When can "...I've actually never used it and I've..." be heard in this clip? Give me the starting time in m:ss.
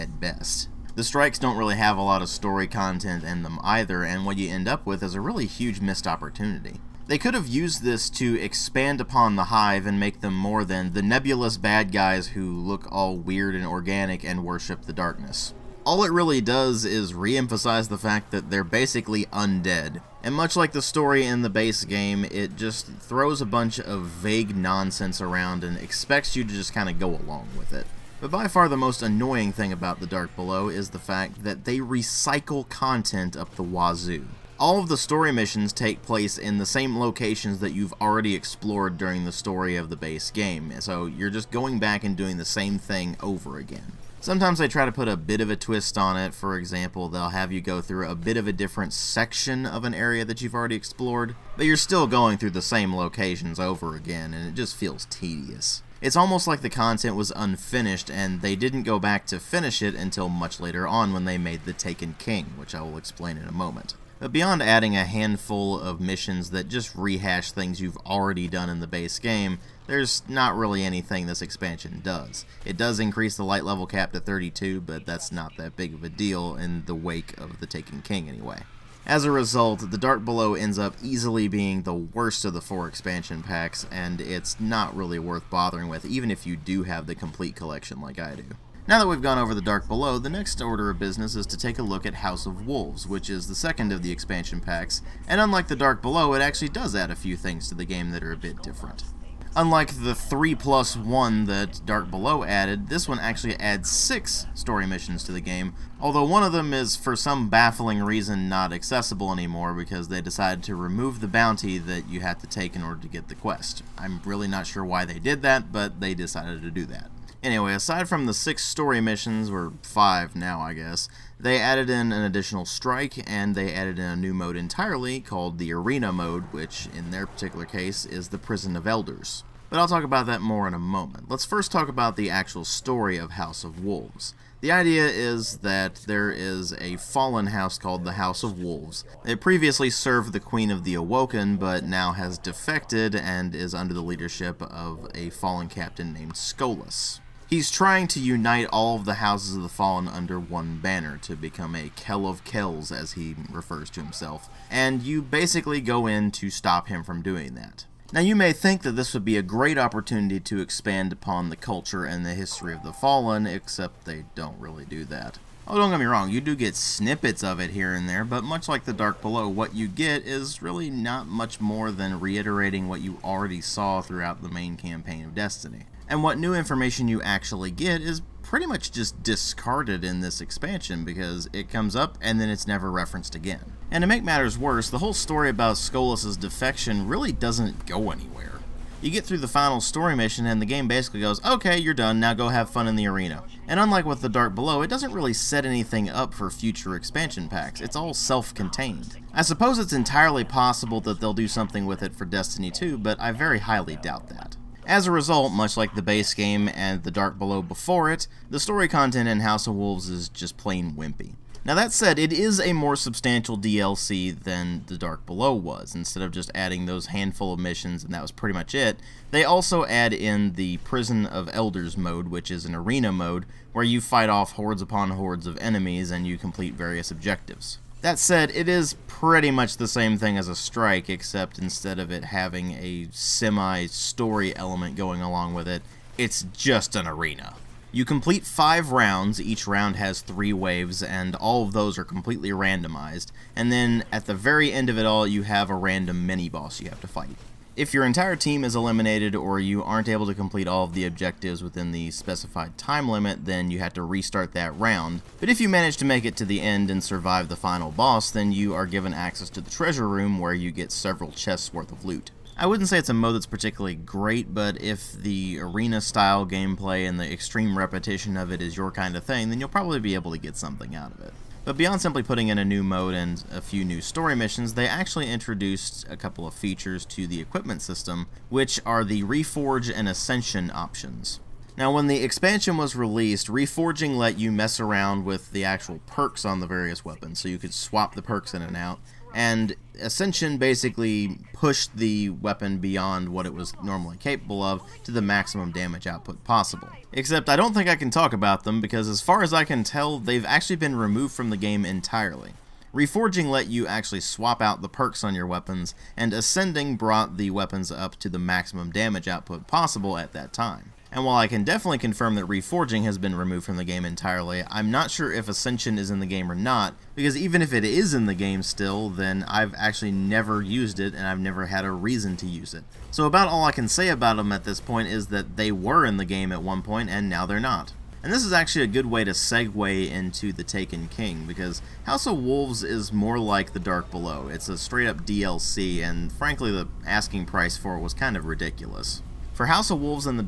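5:19.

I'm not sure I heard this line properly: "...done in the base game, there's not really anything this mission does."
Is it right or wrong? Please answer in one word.
wrong.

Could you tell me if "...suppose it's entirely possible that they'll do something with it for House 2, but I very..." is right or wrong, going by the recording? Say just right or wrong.
wrong.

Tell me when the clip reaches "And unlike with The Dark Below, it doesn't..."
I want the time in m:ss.
3:13.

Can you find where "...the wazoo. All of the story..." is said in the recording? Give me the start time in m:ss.
0:33.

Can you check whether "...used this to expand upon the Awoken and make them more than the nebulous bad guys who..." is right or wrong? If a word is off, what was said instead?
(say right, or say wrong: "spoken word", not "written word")
wrong: "Hive", not "Awoken".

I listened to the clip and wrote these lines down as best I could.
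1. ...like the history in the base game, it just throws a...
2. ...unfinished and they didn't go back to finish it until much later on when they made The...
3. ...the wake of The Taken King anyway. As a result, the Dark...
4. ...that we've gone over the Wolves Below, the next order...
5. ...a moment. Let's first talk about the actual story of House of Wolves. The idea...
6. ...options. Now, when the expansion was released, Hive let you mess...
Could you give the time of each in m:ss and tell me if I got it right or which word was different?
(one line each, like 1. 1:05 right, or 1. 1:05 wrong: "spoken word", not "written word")
1. 0:20 wrong: "story", not "history"
2. 0:57 right
3. 1:16 right
4. 1:28 wrong: "Dark", not "Wolves"
5. 2:10 right
6. 4:40 wrong: "Reforging", not "Hive".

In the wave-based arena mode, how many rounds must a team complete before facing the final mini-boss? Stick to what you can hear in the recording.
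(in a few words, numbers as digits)
5.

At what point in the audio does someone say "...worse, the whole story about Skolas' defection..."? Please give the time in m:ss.
3:04.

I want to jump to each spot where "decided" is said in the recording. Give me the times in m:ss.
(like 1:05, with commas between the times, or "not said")
1:50, 1:56.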